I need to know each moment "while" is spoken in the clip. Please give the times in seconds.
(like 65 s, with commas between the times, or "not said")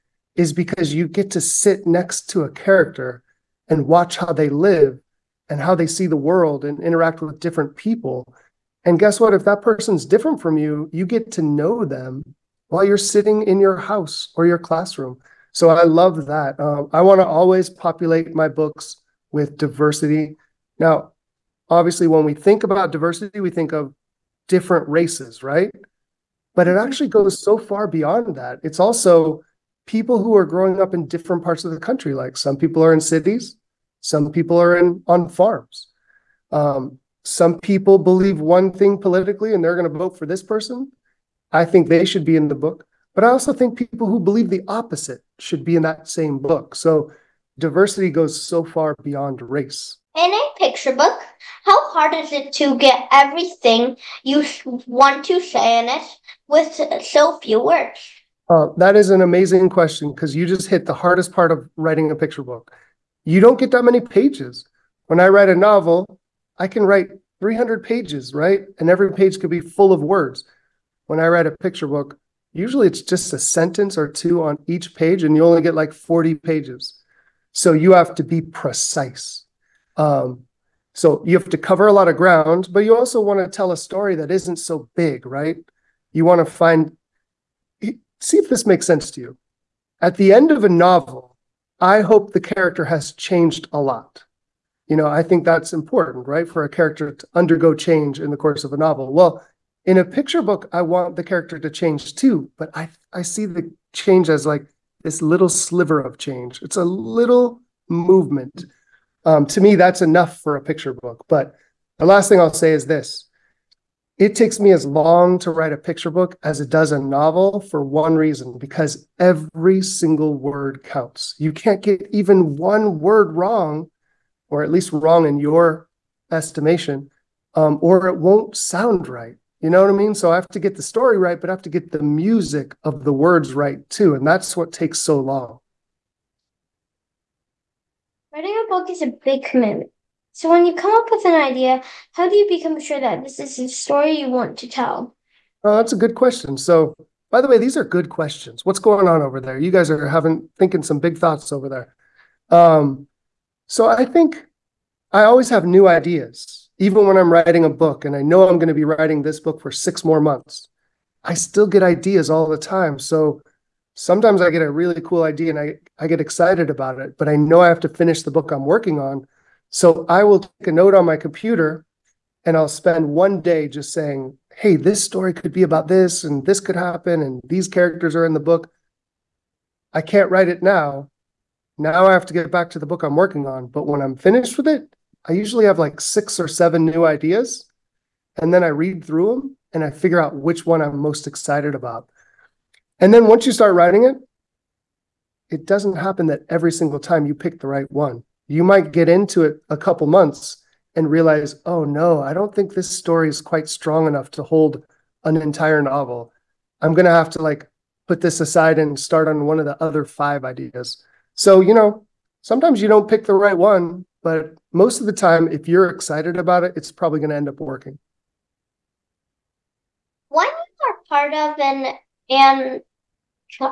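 12 s.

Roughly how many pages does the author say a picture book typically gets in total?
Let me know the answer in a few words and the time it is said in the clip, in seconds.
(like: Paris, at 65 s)
40, at 75 s.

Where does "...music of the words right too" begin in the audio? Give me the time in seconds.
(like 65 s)
132 s.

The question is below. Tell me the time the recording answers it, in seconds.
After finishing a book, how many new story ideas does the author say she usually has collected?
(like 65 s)
186 s.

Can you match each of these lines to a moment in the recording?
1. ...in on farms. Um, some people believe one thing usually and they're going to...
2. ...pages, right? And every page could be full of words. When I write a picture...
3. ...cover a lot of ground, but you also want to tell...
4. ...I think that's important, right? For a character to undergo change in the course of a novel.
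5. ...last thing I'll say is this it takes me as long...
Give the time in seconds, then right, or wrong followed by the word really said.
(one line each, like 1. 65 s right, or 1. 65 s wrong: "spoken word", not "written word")
1. 34 s wrong: "politically", not "usually"
2. 67 s right
3. 81 s right
4. 95 s right
5. 112 s right.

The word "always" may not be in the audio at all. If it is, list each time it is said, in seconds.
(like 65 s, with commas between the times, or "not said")
17 s, 155 s.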